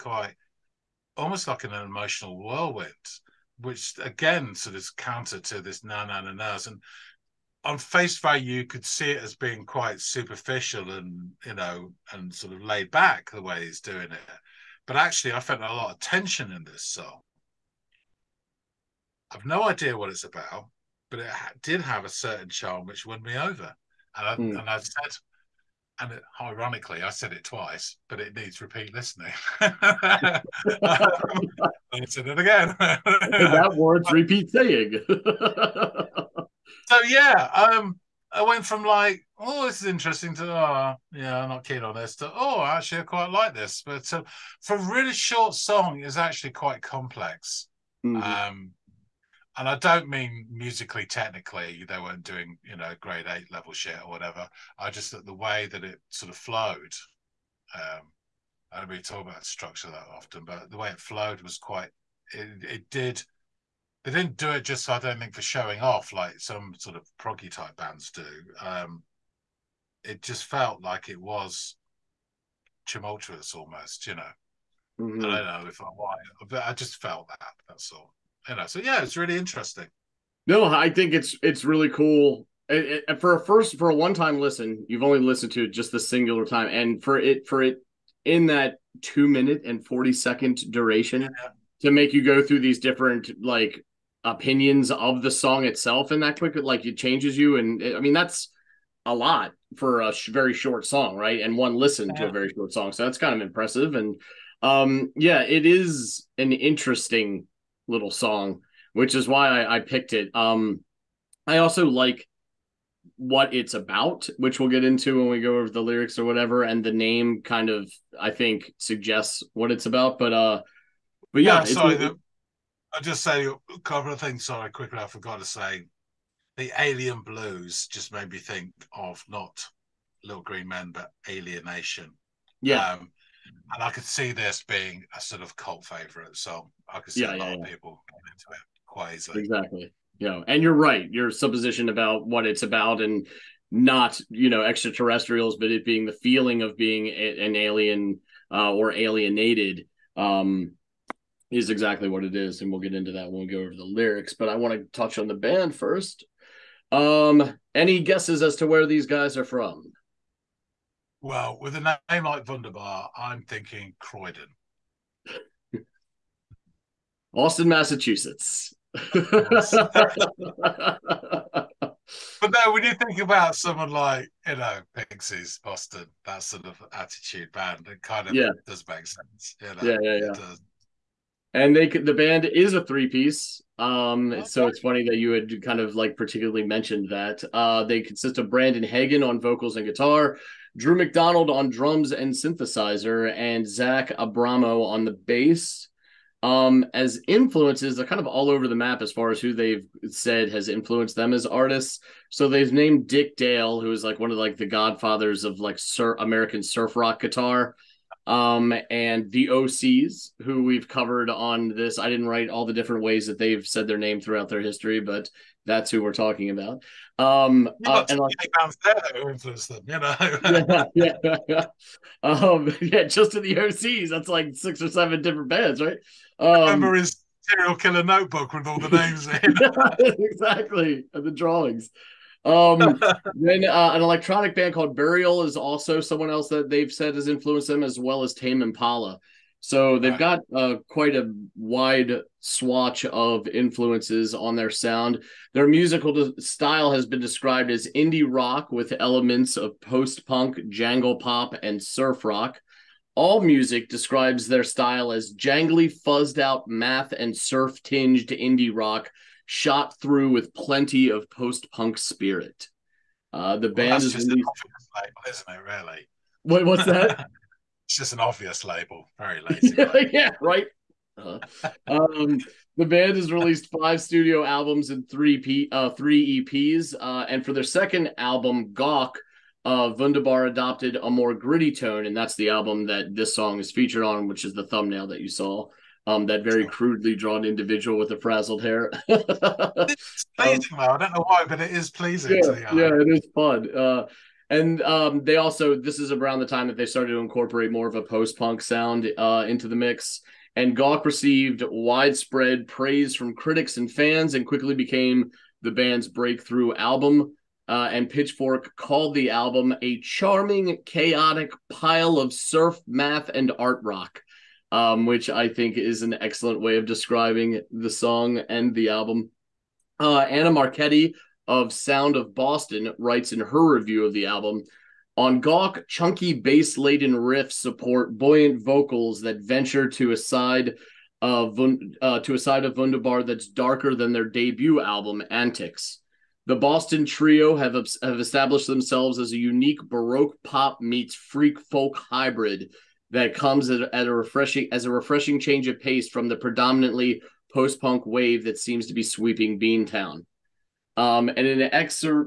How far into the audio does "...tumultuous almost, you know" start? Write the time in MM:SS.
01:12.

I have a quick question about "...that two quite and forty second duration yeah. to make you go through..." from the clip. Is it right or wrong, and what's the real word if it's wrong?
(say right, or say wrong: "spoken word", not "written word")
wrong: "minute", not "quite".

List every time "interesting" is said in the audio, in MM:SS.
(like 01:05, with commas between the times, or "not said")
00:39, 01:19, 01:46.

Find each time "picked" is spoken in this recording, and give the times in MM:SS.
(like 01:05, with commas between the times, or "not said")
01:49.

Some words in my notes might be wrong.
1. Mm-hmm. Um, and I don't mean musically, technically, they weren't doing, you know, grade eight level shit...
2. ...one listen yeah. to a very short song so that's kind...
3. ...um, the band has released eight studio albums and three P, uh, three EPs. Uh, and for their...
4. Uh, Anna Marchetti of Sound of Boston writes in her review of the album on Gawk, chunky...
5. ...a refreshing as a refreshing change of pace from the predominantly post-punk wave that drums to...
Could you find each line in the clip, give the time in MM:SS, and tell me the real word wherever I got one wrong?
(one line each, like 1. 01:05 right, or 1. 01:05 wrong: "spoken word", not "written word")
1. 00:48 right
2. 01:41 right
3. 04:31 wrong: "five", not "eight"
4. 05:19 right
5. 05:44 wrong: "seems", not "drums".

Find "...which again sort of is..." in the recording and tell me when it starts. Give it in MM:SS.
00:03.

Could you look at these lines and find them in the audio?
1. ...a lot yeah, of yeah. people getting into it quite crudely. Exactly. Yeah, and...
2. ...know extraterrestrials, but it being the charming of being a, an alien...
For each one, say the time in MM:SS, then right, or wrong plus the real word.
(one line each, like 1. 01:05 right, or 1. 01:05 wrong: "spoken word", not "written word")
1. 02:17 wrong: "easily", not "crudely"
2. 02:24 wrong: "feeling", not "charming".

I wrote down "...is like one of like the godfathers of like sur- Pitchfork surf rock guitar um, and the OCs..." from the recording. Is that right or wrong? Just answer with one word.
wrong.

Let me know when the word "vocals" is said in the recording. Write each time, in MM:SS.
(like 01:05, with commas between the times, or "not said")
03:09, 05:28.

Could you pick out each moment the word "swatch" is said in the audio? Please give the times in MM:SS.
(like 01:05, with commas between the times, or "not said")
04:02.